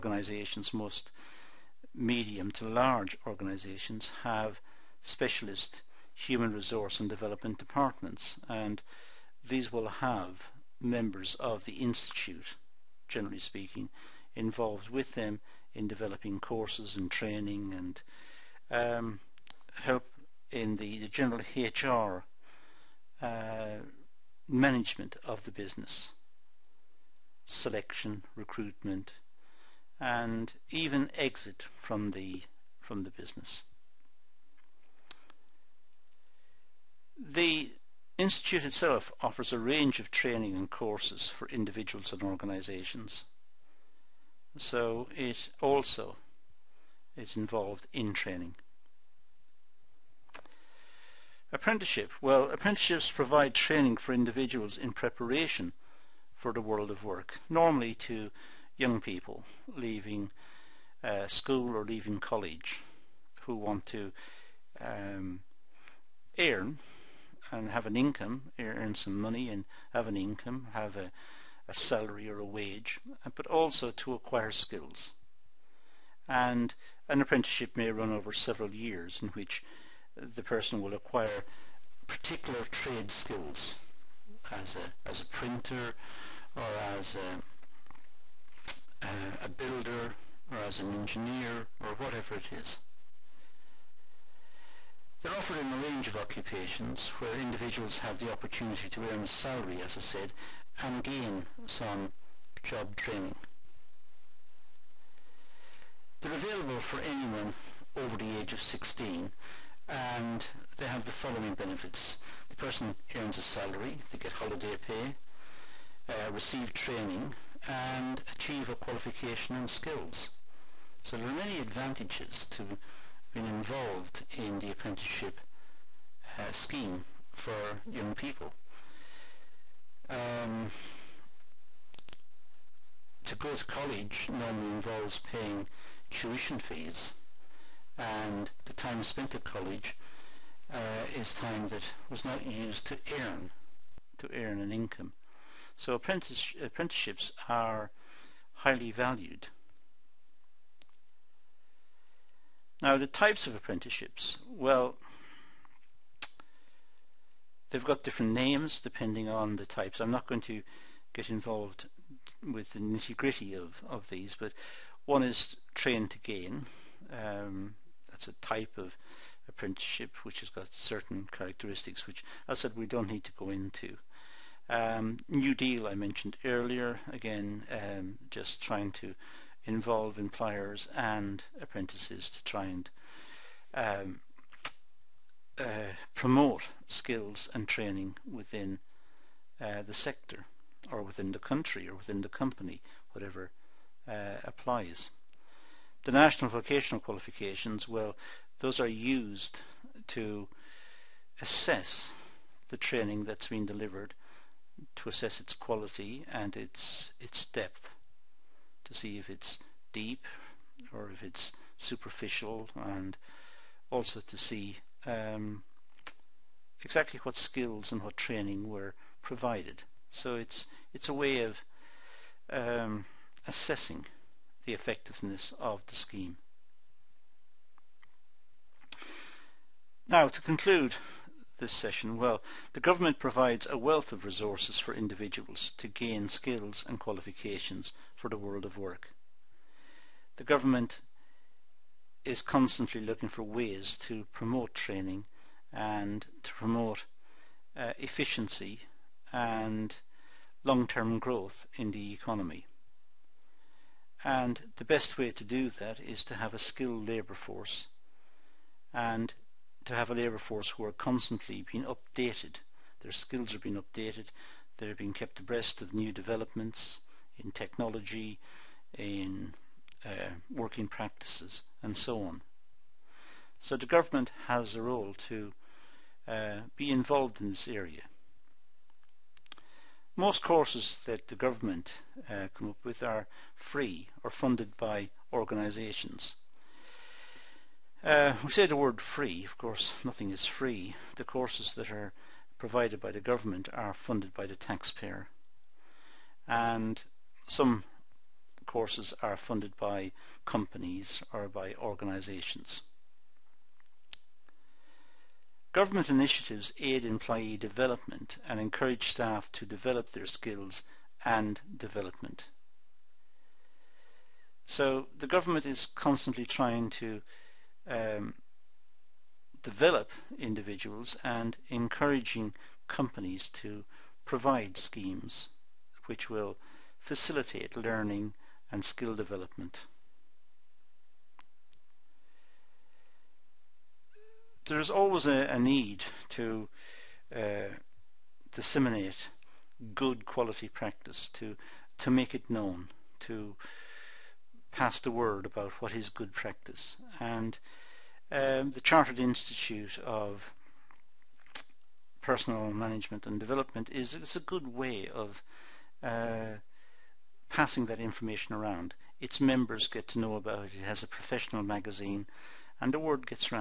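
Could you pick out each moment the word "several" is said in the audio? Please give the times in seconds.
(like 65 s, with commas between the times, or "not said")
78 s.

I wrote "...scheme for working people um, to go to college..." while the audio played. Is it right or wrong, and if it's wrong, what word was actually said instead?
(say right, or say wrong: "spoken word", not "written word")
wrong: "young", not "working".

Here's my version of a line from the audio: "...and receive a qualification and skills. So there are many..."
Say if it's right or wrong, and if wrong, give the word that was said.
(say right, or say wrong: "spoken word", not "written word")
wrong: "achieve", not "receive".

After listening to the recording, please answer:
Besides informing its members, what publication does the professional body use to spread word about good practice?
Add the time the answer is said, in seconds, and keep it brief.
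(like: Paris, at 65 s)
A professional magazine, at 361 s.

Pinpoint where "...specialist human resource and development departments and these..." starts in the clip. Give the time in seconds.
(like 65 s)
5 s.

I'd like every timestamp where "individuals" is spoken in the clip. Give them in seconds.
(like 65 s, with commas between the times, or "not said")
41 s, 54 s, 97 s, 234 s, 320 s.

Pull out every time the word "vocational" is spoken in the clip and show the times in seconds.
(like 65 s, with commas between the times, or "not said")
196 s.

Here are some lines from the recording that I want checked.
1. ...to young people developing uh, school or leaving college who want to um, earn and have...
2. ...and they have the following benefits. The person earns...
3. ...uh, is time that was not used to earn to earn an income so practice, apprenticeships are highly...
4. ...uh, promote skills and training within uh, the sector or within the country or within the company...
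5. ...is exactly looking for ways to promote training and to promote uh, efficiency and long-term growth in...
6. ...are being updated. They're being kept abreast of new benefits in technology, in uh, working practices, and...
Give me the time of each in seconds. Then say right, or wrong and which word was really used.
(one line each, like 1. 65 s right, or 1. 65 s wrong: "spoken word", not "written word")
1. 57 s wrong: "leaving", not "developing"
2. 109 s right
3. 140 s wrong: "apprentice", not "practice"
4. 185 s right
5. 242 s wrong: "constantly", not "exactly"
6. 263 s wrong: "developments", not "benefits".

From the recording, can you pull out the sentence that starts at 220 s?
So it's it's a way of um, assessing the effectiveness of the scheme.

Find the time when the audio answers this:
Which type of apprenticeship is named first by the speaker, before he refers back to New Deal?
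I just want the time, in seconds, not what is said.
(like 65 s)
165 s.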